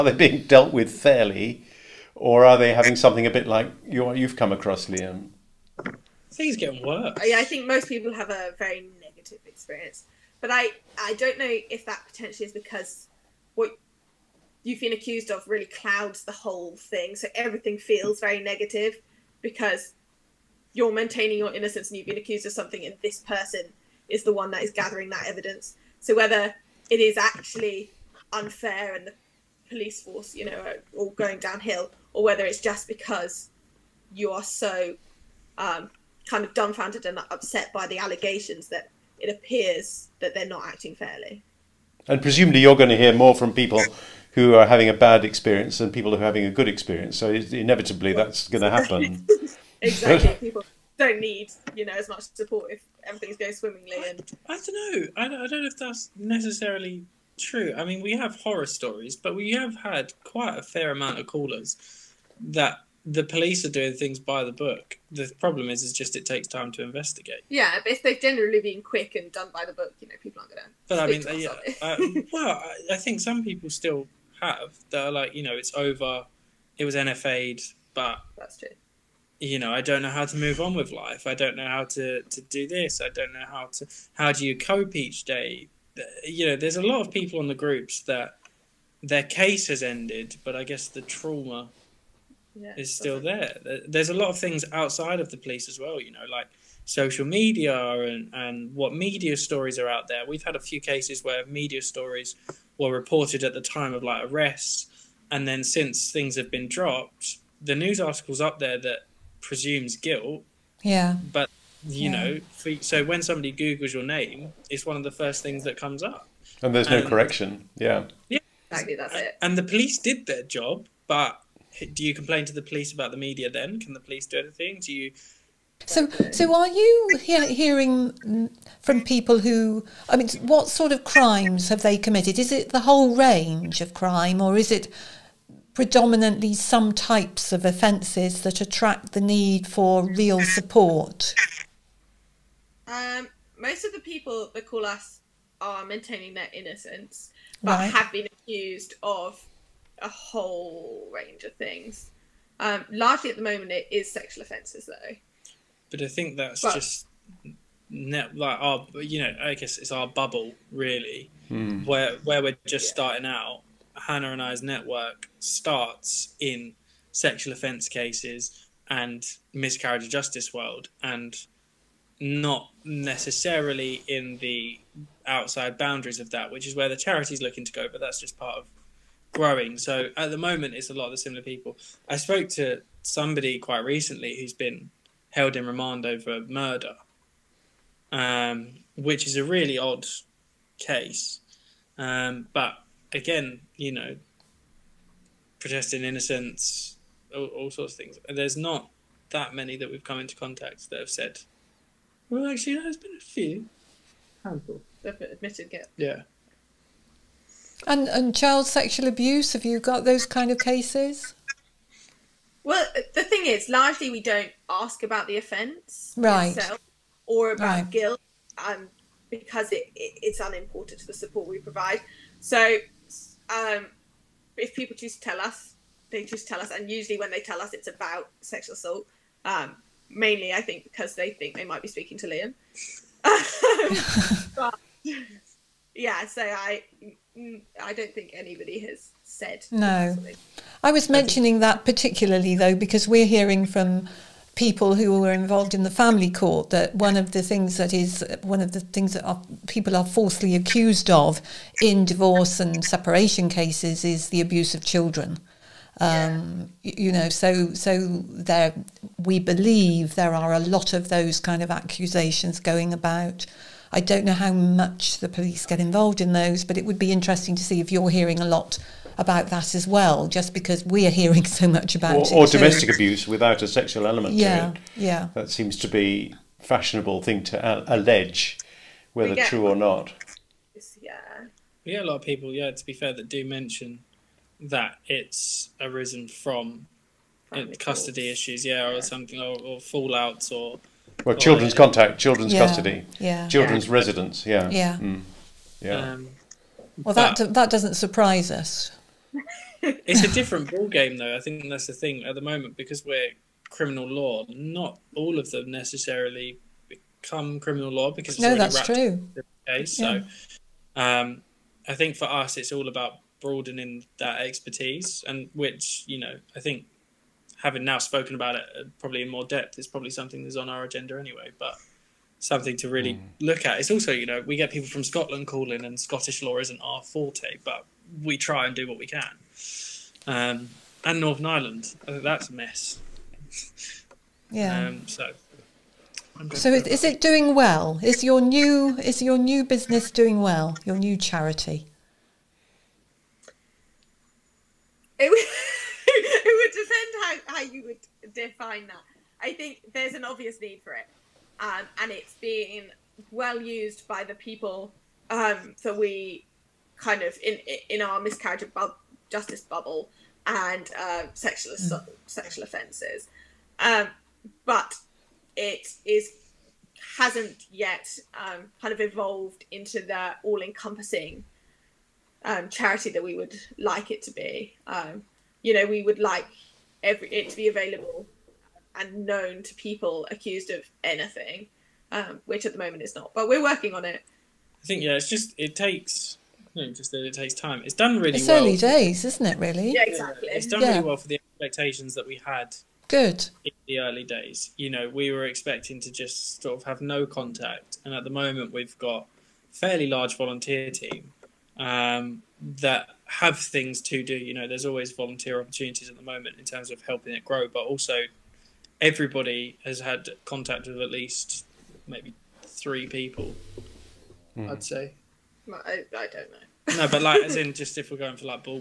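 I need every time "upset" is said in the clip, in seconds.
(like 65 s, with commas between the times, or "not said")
37 s.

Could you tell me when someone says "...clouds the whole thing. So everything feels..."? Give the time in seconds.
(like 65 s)
15 s.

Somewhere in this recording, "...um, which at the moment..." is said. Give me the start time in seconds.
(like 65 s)
382 s.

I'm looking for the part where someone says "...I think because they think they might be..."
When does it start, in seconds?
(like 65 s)
230 s.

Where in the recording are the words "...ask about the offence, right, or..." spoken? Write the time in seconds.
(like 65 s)
214 s.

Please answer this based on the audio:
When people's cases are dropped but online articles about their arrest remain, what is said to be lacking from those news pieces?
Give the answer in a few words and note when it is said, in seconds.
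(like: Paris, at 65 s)
correction, at 117 s.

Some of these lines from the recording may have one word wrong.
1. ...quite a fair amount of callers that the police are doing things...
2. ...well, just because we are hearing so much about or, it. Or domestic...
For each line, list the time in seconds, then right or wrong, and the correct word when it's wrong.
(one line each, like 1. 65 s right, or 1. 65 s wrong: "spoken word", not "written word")
1. 60 s right
2. 269 s right.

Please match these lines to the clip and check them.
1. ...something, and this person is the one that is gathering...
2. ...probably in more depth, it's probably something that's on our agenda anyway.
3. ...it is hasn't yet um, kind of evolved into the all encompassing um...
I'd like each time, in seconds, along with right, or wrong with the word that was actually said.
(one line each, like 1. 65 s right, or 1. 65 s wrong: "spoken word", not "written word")
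1. 22 s right
2. 318 s right
3. 365 s right.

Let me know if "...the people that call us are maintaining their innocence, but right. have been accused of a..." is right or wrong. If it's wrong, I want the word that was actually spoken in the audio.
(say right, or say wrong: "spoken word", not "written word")
right.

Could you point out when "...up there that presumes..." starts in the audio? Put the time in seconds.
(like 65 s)
108 s.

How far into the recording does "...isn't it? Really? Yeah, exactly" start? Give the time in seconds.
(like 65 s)
389 s.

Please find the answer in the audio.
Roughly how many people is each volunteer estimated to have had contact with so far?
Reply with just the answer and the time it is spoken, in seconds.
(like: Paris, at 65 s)
3, at 412 s.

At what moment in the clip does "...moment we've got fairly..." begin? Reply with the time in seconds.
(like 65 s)
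398 s.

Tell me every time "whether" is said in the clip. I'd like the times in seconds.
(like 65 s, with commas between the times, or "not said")
26 s, 32 s, 279 s.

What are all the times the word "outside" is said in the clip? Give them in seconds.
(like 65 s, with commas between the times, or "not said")
94 s, 175 s.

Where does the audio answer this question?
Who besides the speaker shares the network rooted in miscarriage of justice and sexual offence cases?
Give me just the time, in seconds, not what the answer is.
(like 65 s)
163 s.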